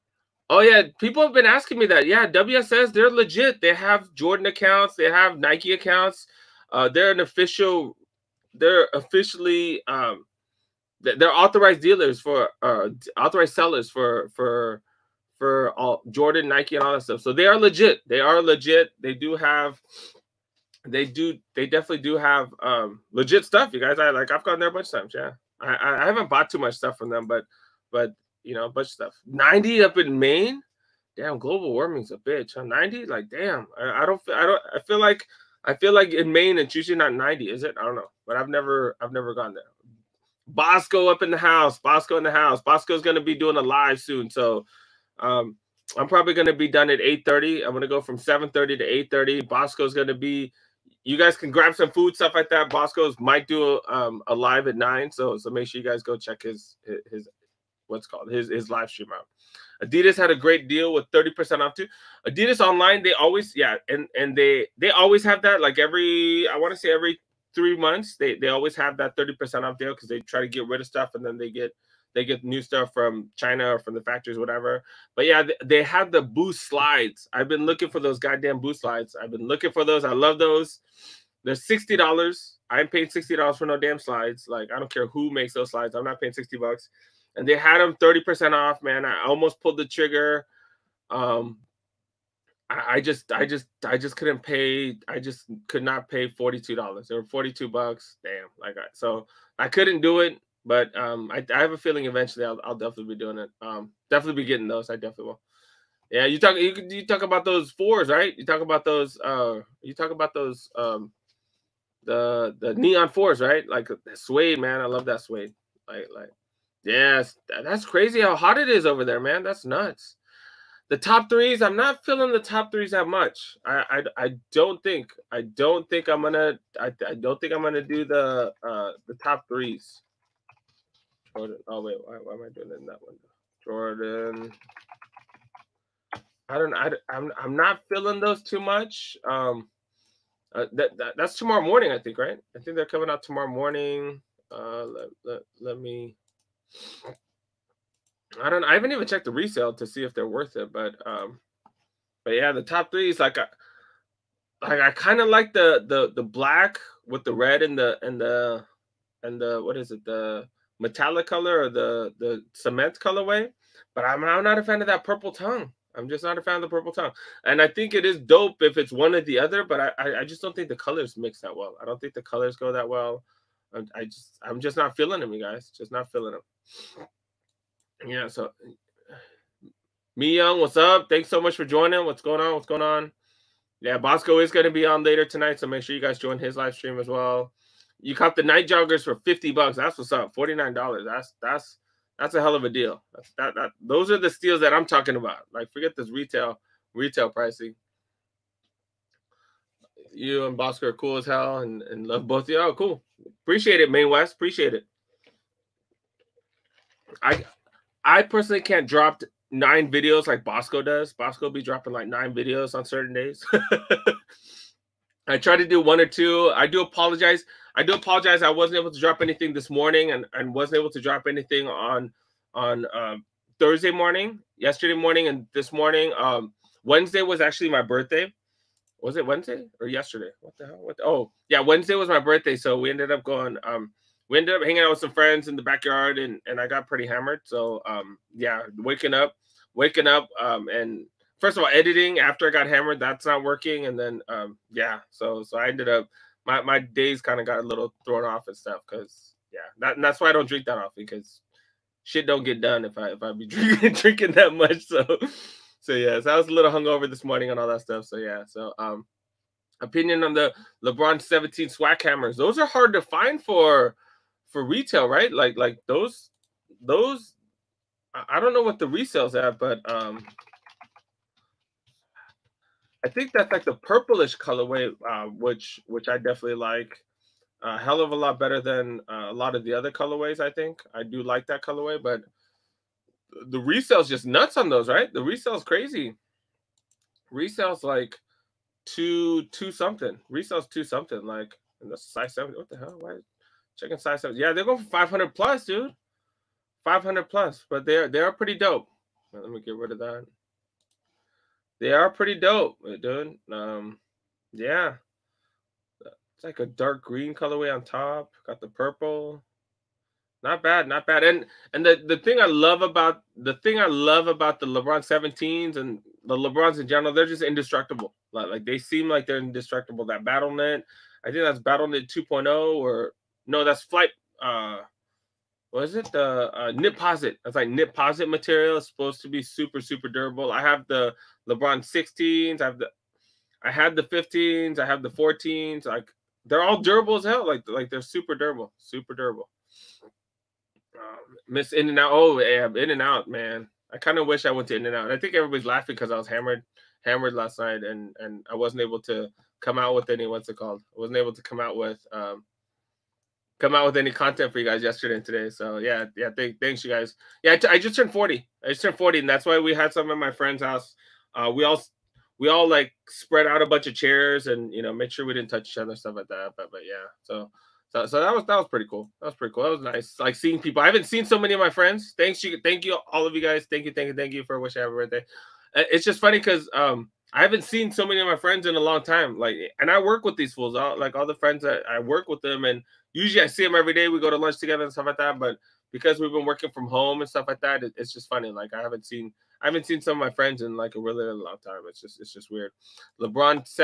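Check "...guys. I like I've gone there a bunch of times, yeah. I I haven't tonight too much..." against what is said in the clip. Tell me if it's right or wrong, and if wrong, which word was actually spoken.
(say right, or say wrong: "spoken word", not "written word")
wrong: "bought", not "tonight".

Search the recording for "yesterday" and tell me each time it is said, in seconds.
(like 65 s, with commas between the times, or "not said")
224 s, 229 s, 354 s.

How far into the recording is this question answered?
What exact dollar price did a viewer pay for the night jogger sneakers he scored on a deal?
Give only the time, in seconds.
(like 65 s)
190 s.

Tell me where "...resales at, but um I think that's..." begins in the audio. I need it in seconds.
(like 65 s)
268 s.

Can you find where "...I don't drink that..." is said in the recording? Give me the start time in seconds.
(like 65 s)
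250 s.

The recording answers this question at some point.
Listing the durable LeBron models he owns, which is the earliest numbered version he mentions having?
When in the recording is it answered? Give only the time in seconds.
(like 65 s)
335 s.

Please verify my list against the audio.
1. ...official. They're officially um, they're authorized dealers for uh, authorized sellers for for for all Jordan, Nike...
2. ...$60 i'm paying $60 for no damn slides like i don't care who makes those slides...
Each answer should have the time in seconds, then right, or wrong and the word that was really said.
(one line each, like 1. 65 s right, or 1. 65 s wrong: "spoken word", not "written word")
1. 7 s right
2. 81 s right.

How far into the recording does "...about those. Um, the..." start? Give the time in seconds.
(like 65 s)
110 s.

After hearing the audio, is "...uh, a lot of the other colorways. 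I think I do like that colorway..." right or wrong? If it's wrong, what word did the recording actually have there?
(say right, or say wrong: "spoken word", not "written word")
right.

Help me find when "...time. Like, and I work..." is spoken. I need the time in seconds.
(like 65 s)
379 s.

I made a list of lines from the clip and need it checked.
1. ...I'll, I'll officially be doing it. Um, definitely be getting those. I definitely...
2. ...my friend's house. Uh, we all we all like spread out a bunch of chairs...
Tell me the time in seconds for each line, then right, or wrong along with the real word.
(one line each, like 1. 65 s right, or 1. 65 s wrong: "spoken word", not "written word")
1. 102 s wrong: "definitely", not "officially"
2. 360 s right.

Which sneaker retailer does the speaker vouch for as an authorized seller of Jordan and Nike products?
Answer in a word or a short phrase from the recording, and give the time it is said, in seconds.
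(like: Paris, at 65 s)
WSS, at 2 s.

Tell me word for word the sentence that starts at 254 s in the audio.
So so yeah, so I was a little hungover this morning and all that stuff.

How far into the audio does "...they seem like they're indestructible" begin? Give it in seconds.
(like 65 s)
318 s.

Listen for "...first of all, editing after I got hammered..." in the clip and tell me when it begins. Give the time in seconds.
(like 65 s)
241 s.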